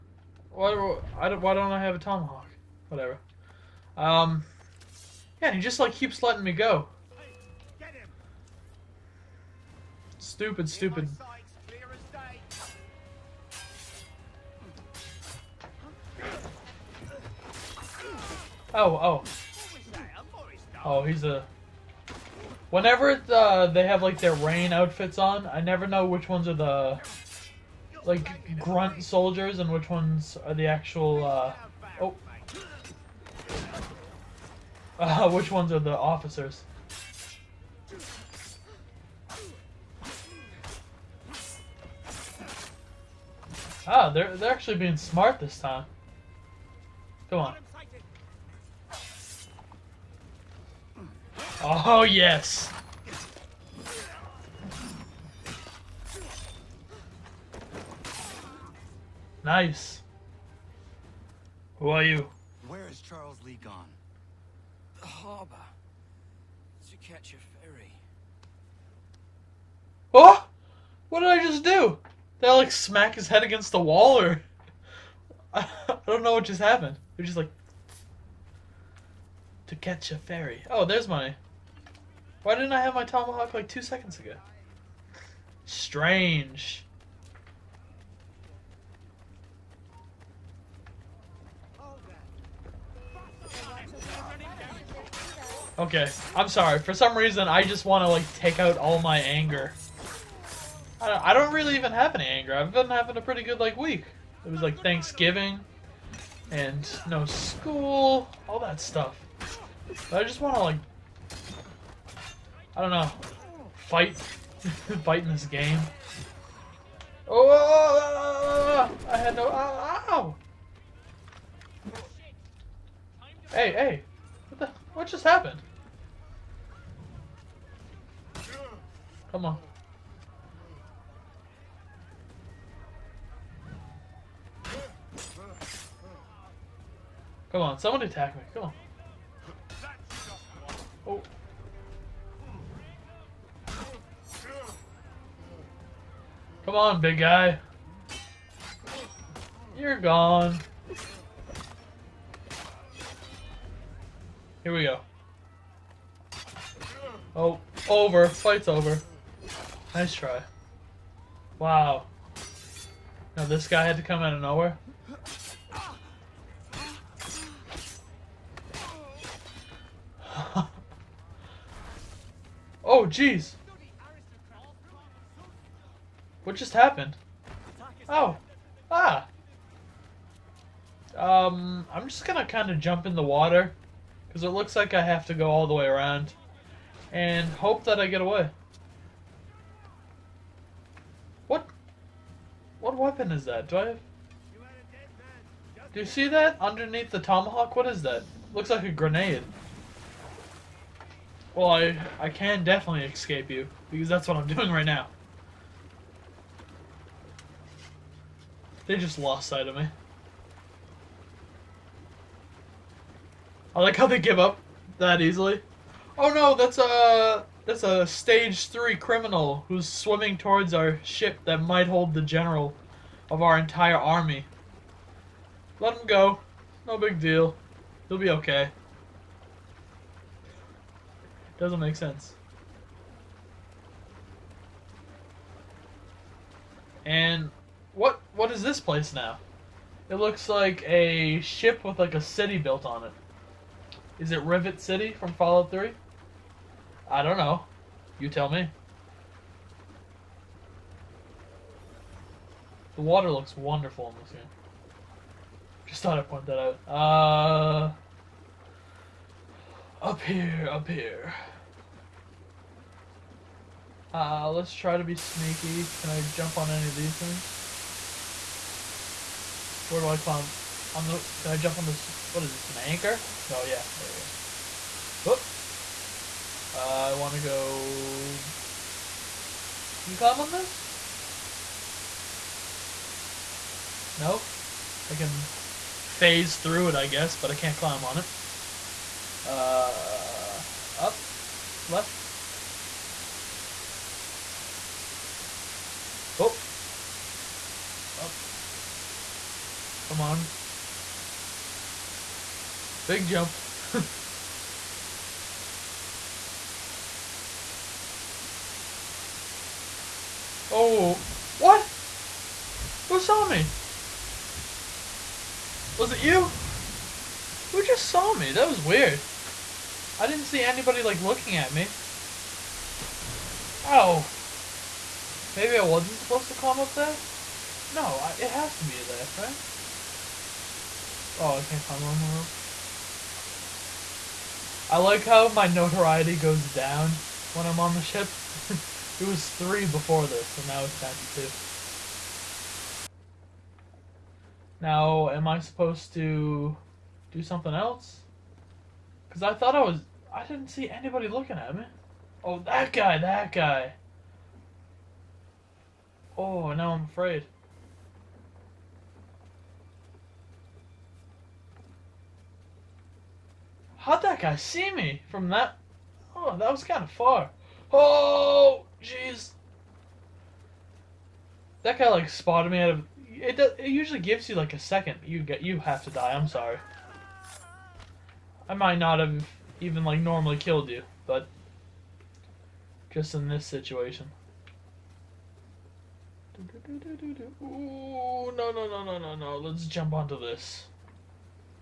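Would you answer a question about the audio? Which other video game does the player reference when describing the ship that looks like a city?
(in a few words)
Fallout 3.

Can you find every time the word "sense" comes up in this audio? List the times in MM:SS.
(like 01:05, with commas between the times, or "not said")
03:51.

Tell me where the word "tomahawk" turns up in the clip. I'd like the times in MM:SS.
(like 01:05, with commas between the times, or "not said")
00:01, 01:23, 03:17.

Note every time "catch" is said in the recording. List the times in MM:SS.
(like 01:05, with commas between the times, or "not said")
01:07, 01:19.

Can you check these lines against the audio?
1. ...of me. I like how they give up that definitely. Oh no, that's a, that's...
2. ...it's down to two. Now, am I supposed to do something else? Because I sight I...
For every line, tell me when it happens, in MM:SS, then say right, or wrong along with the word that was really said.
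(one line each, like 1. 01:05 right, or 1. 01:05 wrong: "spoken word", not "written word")
1. 03:29 wrong: "easily", not "definitely"
2. 05:40 wrong: "thought", not "sight".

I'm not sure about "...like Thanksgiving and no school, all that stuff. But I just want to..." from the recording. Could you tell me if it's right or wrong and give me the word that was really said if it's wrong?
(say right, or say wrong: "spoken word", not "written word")
right.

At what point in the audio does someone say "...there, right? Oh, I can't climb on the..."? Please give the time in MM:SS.
05:29.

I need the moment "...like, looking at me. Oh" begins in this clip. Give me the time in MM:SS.
05:21.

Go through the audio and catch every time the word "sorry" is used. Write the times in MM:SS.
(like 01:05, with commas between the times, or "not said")
01:36, 06:16.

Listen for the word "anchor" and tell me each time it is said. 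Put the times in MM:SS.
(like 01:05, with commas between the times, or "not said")
04:32.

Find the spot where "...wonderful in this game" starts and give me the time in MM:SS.
04:13.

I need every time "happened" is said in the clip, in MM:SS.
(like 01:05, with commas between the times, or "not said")
01:16, 02:05, 02:56.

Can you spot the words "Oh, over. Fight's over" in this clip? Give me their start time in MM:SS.
02:37.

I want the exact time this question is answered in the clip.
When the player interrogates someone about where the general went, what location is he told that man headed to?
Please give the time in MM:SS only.
01:05.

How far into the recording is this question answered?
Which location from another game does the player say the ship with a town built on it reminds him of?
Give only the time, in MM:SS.
04:04.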